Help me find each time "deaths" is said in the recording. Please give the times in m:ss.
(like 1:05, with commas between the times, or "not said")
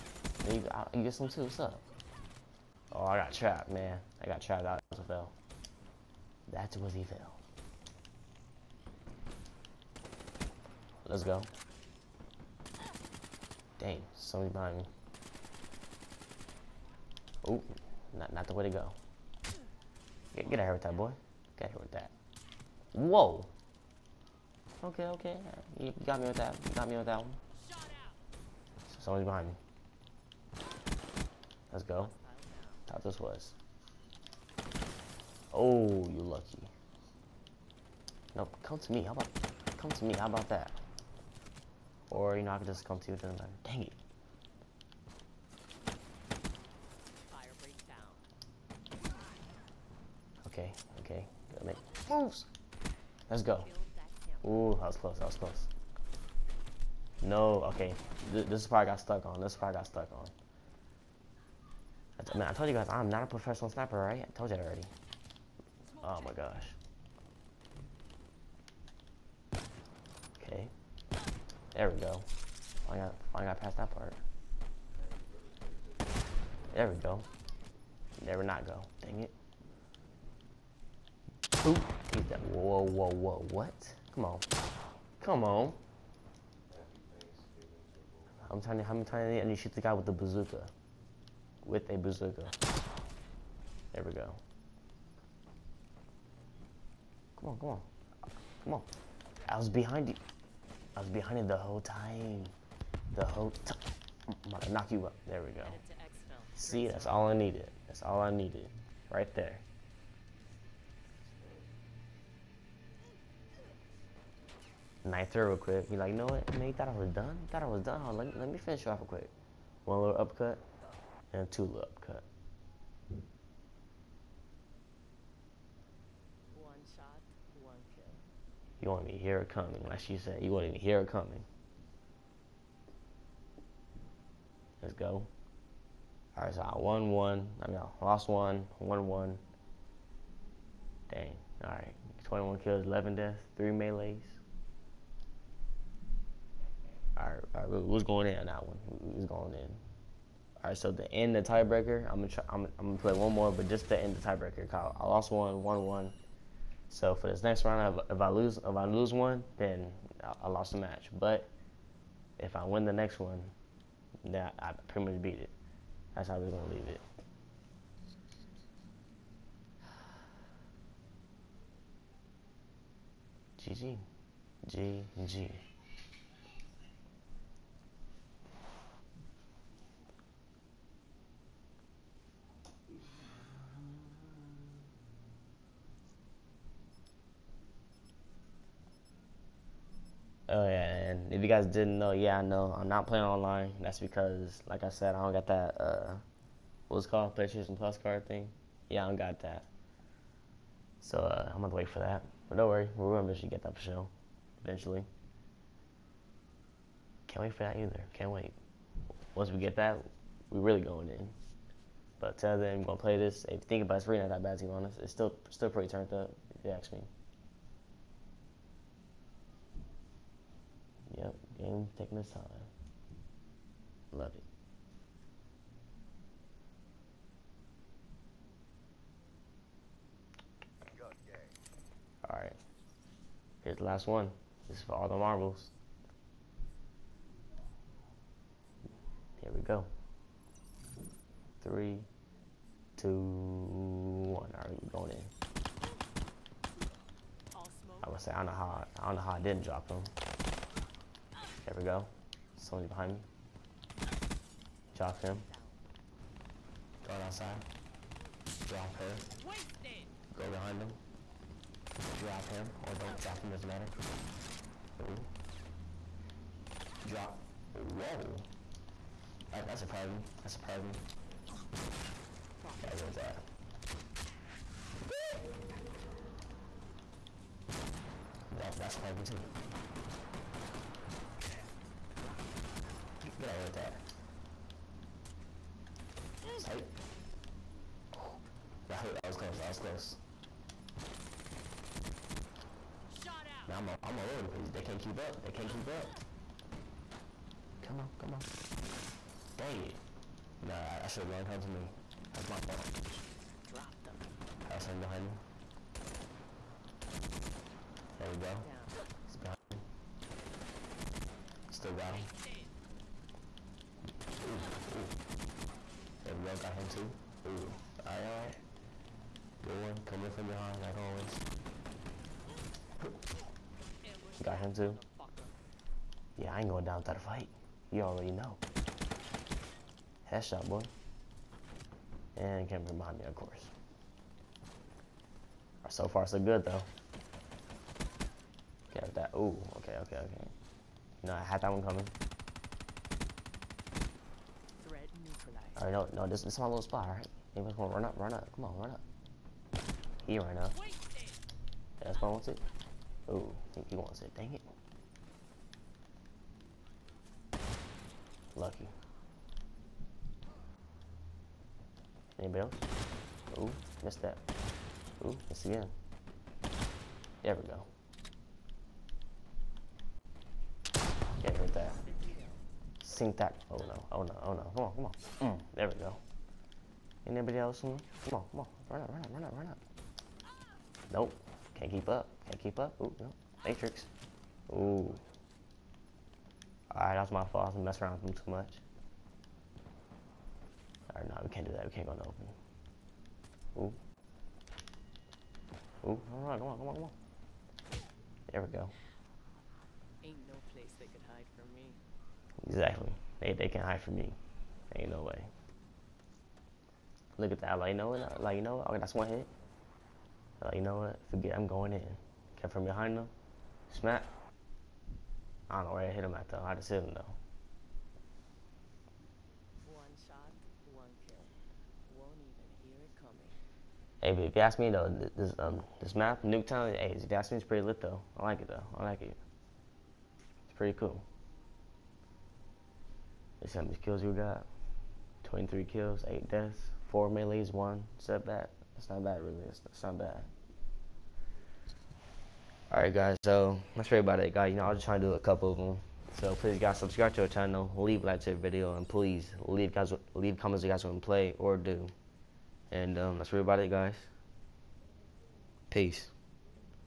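2:23, 7:16.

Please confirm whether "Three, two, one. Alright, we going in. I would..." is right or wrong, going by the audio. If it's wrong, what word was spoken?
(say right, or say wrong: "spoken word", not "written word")
right.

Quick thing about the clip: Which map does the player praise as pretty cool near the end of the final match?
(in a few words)
Nuketown.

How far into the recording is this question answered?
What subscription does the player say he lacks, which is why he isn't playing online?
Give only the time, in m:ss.
3:17.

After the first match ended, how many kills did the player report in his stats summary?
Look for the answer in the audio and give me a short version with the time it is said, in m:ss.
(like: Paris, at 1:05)
21, at 2:22.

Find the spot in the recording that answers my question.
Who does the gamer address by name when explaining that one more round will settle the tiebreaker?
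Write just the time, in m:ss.
2:34.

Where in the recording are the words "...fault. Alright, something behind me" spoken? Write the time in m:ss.
5:02.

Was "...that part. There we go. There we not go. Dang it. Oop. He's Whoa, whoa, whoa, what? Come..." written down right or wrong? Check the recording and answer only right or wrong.
right.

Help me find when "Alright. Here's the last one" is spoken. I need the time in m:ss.
3:52.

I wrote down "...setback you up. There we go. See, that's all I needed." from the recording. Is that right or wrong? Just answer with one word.
wrong.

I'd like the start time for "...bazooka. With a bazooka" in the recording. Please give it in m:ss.
1:30.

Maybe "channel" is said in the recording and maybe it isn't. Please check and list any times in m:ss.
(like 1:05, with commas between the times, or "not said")
7:27.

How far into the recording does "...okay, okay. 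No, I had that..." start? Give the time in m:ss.
5:40.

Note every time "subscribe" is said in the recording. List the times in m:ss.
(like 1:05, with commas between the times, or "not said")
7:26.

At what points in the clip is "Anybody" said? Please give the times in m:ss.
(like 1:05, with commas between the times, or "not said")
5:47, 6:02, 6:17.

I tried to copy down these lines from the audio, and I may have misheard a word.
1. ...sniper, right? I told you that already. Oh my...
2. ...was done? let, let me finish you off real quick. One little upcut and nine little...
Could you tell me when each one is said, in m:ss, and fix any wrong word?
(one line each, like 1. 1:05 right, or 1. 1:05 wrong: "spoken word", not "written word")
1. 1:03 right
2. 1:57 wrong: "two", not "nine".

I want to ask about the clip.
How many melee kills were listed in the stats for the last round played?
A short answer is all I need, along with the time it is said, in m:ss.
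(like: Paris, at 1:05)
4, at 7:17.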